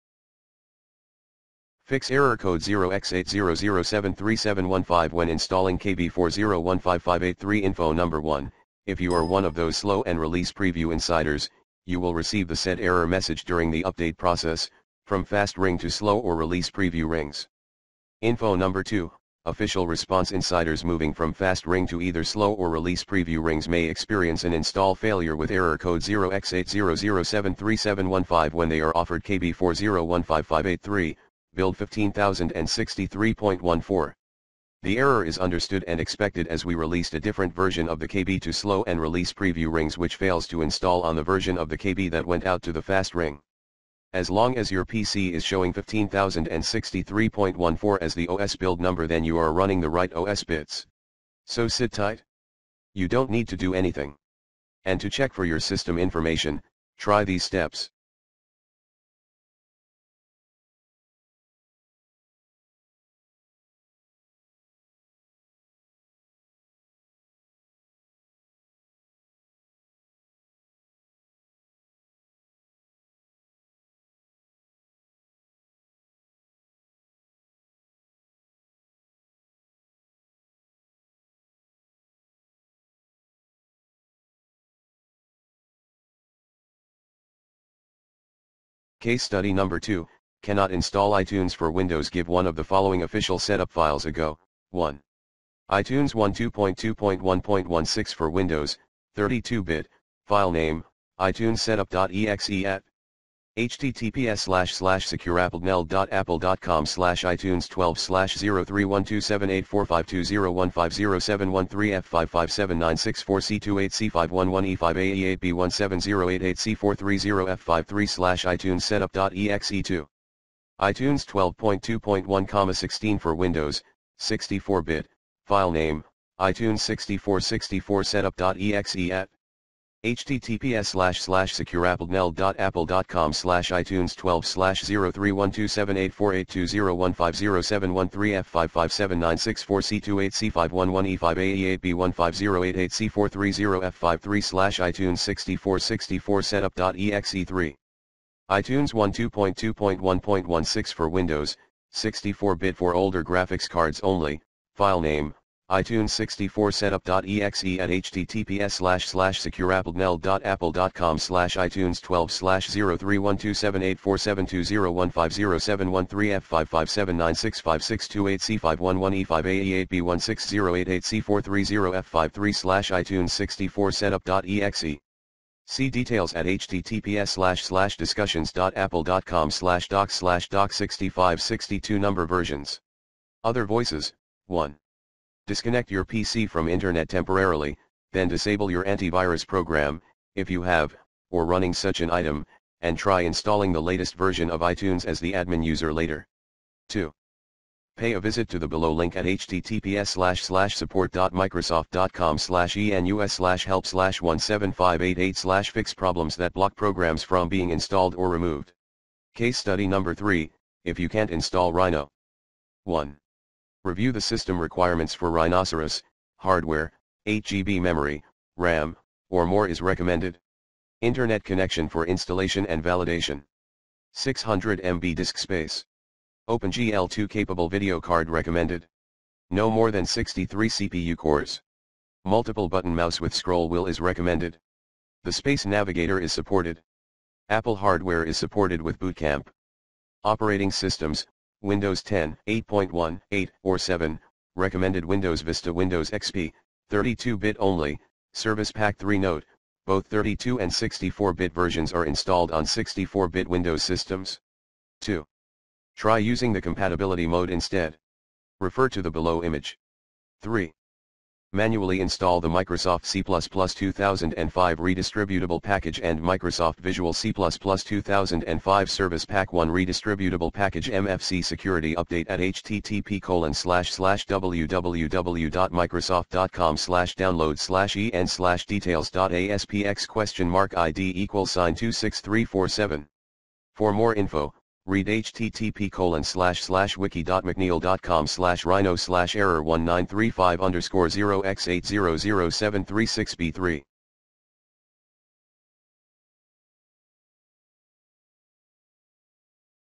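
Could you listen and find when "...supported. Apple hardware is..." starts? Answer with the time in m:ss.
3:56.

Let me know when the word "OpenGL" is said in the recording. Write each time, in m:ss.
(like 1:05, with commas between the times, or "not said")
3:46.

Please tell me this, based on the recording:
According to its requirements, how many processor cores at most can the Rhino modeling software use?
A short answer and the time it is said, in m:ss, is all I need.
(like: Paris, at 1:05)
63, at 3:50.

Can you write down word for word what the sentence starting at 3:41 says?
Internet connection for installation and validation.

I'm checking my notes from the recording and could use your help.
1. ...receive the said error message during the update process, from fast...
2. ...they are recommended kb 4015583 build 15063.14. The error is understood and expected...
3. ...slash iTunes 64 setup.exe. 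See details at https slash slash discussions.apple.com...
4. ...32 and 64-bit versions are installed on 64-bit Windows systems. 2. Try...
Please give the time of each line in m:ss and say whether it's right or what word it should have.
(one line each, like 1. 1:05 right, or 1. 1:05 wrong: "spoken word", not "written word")
1. 0:12 right
2. 0:28 wrong: "offered", not "recommended"
3. 2:52 right
4. 4:10 right.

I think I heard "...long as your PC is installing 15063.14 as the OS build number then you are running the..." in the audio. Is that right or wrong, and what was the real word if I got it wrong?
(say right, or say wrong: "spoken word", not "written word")
wrong: "showing", not "installing".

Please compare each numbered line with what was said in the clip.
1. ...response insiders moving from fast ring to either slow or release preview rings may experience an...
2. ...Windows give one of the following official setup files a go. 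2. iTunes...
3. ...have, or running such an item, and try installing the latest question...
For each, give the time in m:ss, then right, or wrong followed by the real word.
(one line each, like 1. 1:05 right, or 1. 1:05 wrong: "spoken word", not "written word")
1. 0:19 right
2. 1:31 wrong: "1", not "2"
3. 3:10 wrong: "version", not "question".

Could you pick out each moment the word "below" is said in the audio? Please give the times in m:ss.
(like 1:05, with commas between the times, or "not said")
3:18, 4:19.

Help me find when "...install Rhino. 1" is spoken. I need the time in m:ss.
3:31.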